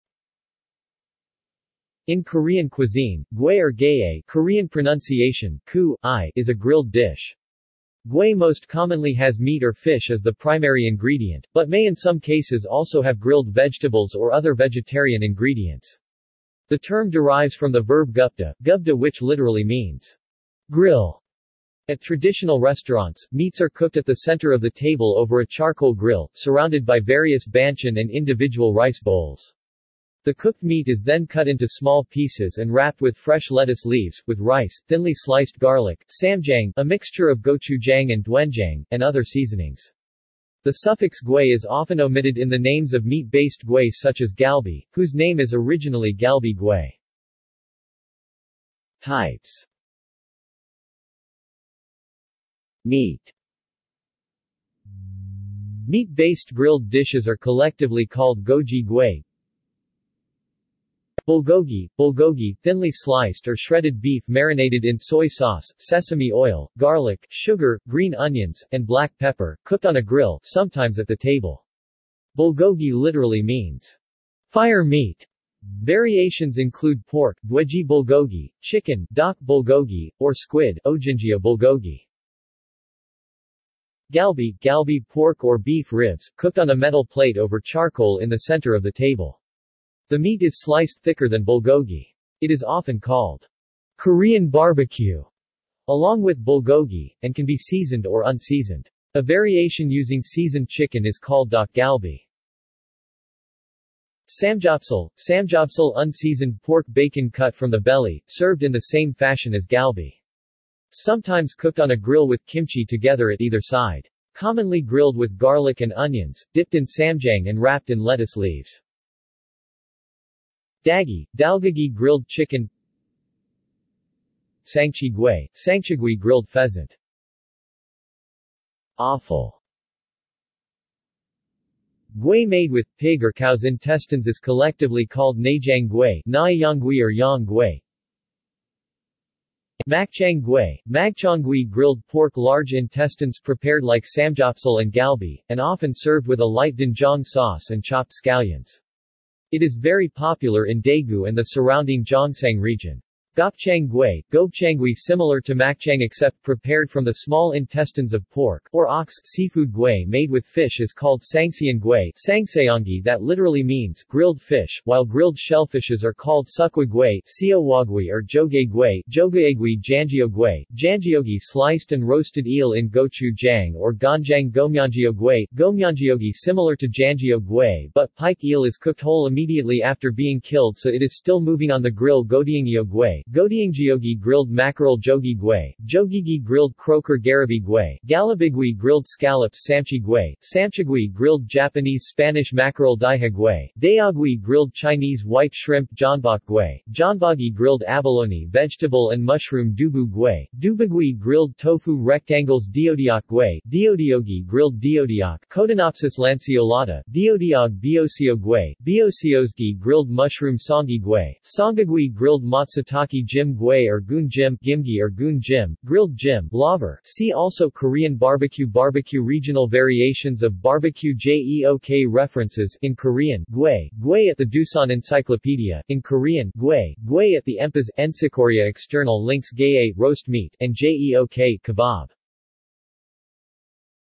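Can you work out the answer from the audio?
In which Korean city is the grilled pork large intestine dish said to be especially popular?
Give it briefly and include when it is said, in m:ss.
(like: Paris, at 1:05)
Daegu, at 2:30.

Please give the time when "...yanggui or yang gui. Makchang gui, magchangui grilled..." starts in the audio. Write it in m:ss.
2:16.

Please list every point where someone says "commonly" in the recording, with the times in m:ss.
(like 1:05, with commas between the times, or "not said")
0:08, 1:54.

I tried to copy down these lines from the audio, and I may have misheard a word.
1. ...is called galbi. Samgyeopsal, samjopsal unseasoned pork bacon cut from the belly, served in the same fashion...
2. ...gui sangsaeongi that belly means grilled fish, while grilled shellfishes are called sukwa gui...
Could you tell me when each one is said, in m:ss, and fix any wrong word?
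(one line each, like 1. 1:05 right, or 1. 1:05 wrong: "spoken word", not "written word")
1. 1:41 right
2. 2:41 wrong: "literally", not "belly".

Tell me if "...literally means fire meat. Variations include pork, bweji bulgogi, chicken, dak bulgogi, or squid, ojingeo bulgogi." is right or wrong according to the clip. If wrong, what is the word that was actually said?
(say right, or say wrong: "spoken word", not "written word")
right.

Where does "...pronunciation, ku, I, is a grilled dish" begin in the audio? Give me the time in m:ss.
0:04.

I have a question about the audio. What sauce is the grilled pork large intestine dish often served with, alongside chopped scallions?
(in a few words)
light doenjang sauce.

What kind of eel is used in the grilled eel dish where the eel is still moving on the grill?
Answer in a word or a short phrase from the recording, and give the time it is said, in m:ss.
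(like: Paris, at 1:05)
pike eel, at 2:58.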